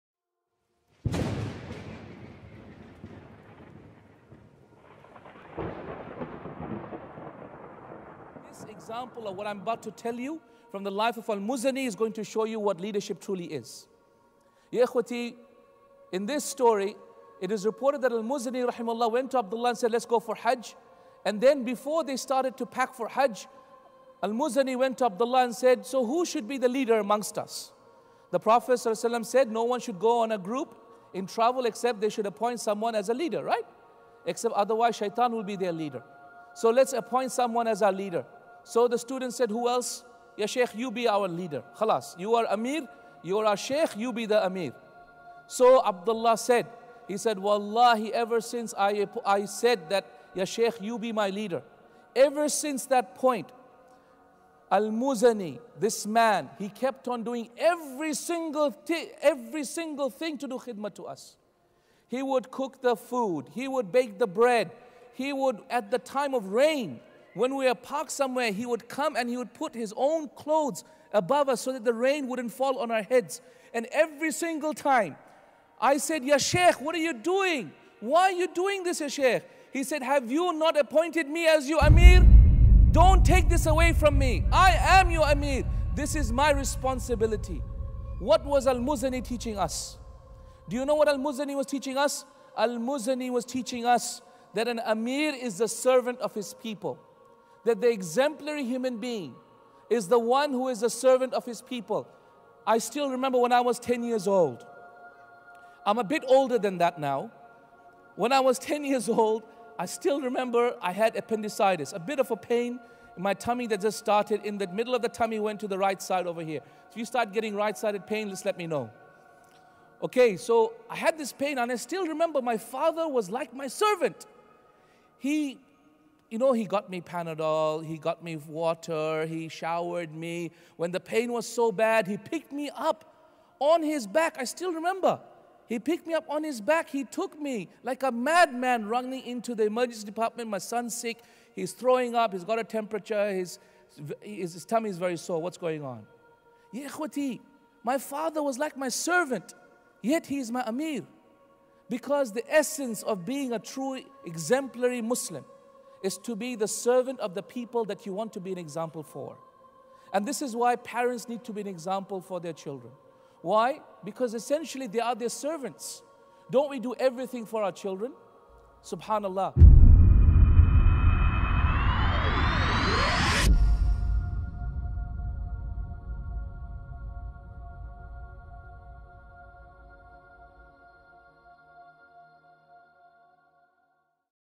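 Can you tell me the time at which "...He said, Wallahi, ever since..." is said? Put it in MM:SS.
00:47.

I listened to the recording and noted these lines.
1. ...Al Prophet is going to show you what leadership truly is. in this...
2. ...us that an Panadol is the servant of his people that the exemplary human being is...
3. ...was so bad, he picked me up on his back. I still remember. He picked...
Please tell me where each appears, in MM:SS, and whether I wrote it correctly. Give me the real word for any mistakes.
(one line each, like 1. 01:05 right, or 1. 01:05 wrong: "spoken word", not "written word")
1. 00:11 wrong: "Muzani", not "Prophet"
2. 01:33 wrong: "Amir", not "Panadol"
3. 02:11 right.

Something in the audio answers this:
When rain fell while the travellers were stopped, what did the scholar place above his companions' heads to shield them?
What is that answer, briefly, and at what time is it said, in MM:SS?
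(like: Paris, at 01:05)
His own clothes, at 01:09.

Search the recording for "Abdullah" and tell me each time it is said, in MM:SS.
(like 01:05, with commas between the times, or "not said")
00:19, 00:25, 00:45.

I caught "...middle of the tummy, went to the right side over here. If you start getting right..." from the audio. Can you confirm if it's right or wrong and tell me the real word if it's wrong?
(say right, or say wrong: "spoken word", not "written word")
right.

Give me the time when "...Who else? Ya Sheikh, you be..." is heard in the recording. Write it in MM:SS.
00:39.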